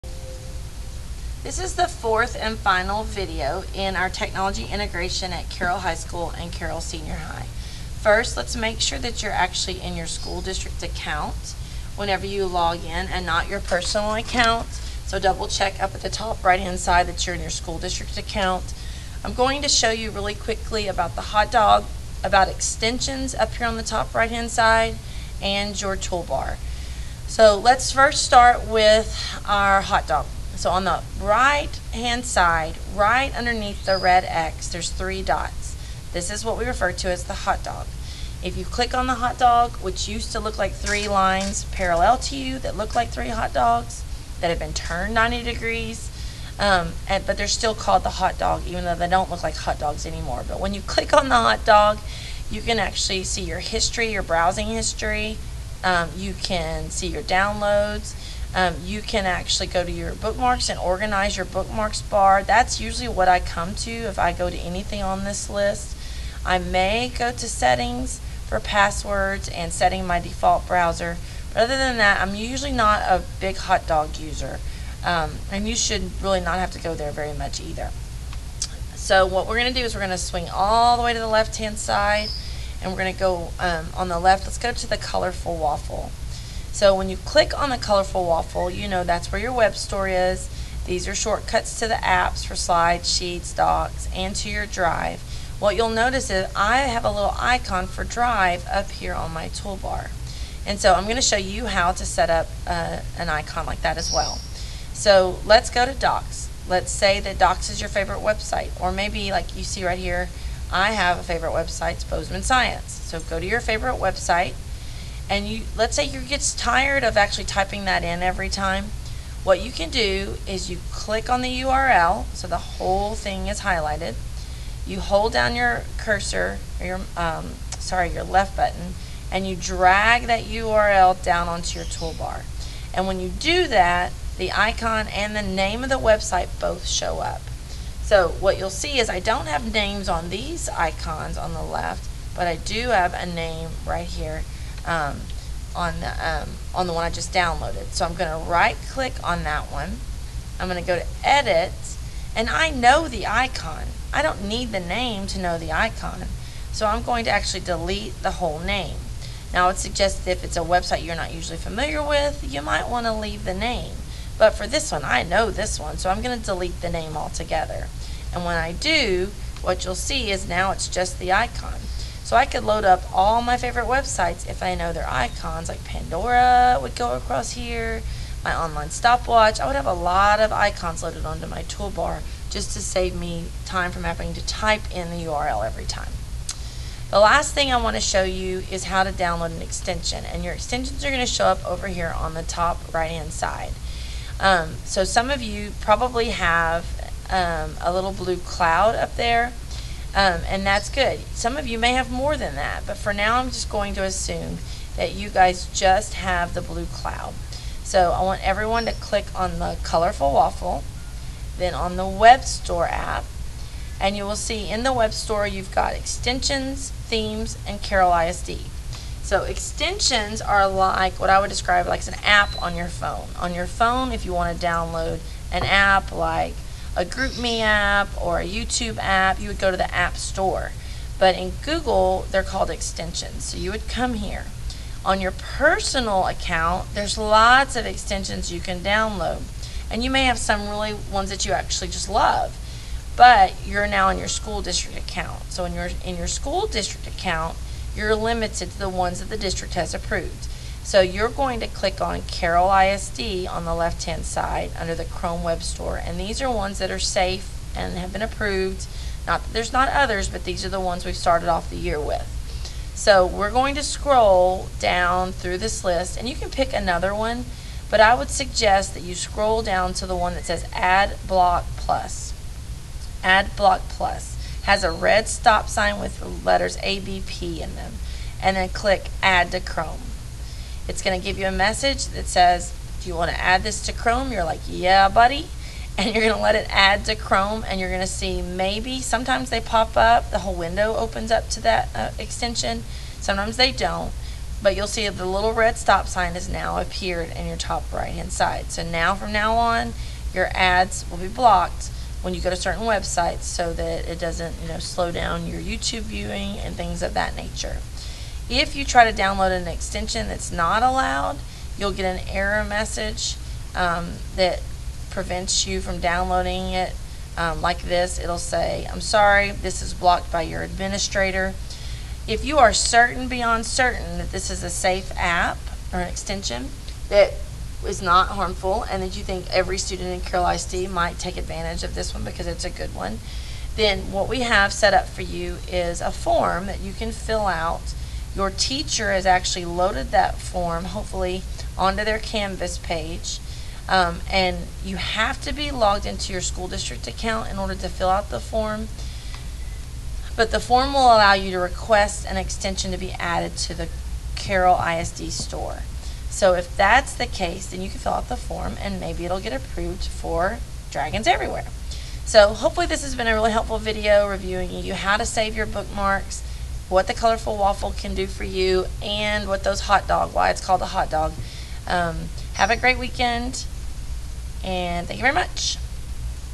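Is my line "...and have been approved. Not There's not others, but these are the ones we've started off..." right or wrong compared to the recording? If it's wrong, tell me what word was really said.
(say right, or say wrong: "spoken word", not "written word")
right.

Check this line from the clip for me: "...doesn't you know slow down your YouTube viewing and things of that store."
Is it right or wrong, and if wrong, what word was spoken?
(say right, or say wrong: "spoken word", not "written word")
wrong: "nature", not "store".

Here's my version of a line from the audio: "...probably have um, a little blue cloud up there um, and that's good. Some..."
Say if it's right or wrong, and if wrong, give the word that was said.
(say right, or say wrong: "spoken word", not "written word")
right.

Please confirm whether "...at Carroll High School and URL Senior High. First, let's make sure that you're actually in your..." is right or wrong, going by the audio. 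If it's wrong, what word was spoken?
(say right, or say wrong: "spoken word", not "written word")
wrong: "Carroll", not "URL".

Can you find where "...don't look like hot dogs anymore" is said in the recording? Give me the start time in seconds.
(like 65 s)
49 s.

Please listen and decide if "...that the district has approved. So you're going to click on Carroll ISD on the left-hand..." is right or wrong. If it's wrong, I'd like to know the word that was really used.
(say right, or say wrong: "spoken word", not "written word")
right.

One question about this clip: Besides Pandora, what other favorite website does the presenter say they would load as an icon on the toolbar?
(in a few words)
Online stopwatch.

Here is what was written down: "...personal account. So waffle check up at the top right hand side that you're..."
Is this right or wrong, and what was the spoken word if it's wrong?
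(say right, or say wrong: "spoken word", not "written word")
wrong: "double", not "waffle".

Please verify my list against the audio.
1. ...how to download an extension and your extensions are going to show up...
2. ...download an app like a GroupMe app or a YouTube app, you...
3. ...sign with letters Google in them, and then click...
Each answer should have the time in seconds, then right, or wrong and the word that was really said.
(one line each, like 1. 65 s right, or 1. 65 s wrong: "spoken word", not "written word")
1. 188 s right
2. 224 s right
3. 275 s wrong: "ABP", not "Google".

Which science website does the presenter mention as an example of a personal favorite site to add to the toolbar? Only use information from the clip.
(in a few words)
Bozeman Science.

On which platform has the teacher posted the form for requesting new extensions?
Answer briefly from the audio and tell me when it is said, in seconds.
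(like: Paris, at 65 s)
Canvas, at 342 s.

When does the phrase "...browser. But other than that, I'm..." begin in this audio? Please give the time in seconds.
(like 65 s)
70 s.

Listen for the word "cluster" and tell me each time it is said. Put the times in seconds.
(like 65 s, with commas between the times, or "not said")
not said.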